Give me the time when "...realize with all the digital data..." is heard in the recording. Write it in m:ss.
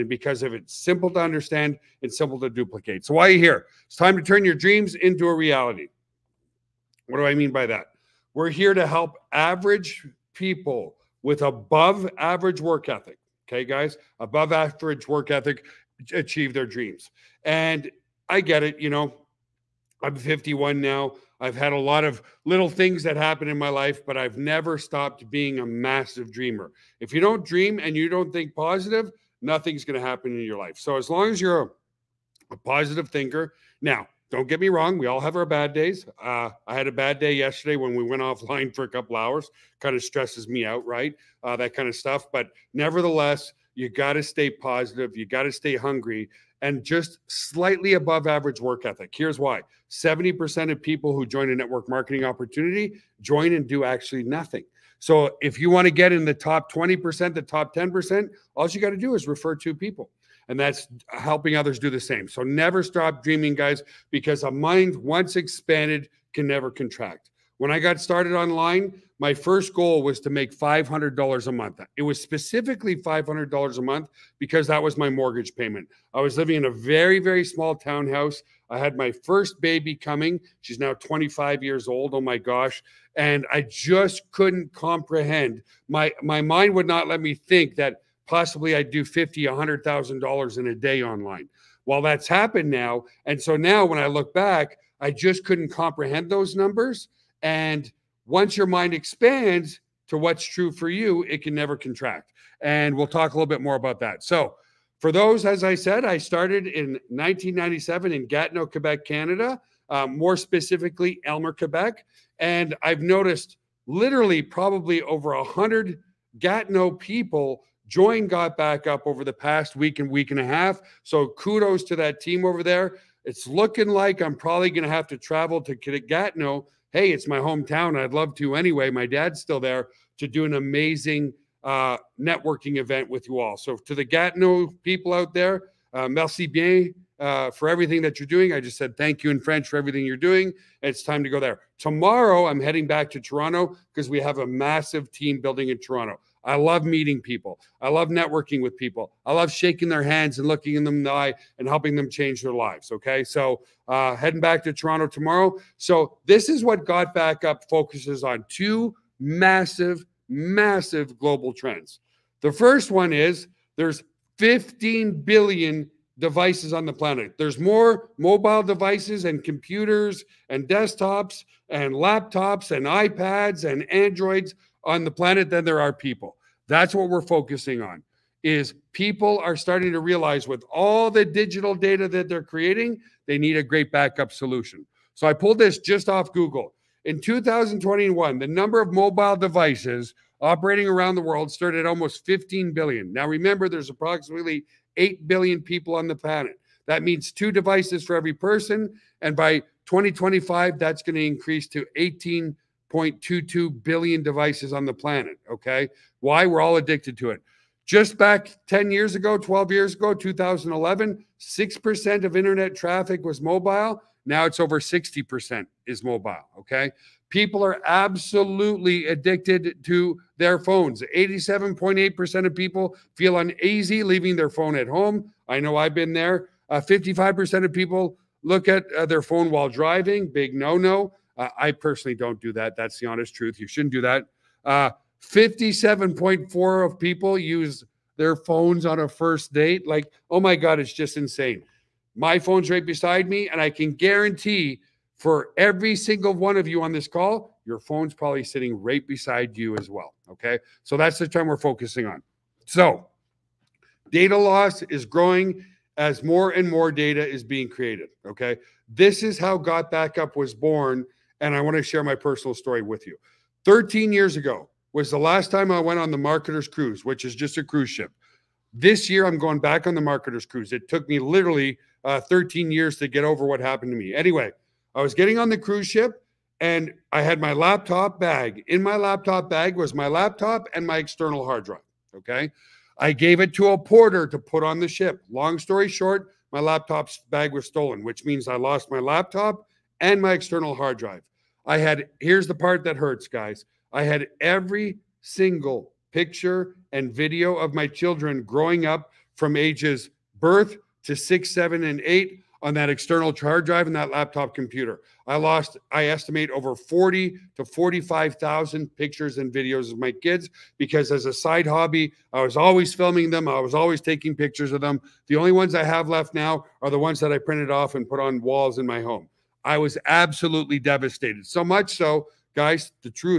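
3:00.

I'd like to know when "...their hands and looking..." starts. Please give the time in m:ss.
2:29.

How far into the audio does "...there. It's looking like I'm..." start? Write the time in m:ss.
2:02.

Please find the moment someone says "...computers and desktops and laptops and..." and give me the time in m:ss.
2:49.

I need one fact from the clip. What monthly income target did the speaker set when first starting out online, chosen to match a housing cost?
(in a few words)
$500.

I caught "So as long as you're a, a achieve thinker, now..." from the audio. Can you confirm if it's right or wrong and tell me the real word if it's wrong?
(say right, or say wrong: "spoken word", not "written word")
wrong: "positive", not "achieve".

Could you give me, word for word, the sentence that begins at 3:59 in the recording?
Like, oh my God, it's just insane.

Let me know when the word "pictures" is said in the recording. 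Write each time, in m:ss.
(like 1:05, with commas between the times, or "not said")
4:56, 5:08, 5:14.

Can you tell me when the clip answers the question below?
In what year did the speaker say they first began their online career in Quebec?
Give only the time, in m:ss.
1:47.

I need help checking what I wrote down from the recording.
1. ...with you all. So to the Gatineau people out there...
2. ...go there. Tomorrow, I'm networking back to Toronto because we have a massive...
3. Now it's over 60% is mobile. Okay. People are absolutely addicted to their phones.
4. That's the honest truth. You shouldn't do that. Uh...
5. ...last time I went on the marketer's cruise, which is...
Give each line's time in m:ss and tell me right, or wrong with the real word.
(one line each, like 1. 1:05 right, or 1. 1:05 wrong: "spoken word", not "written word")
1. 2:13 right
2. 2:21 wrong: "heading", not "networking"
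3. 3:34 right
4. 3:52 right
5. 4:25 right.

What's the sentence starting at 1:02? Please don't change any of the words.
So never stop dreaming, guys, because a mind once expanded can never contract.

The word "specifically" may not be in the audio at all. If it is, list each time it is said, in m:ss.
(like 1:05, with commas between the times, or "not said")
1:12, 1:50.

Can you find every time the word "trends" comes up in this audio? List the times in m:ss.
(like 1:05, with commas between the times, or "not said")
2:41, 4:11.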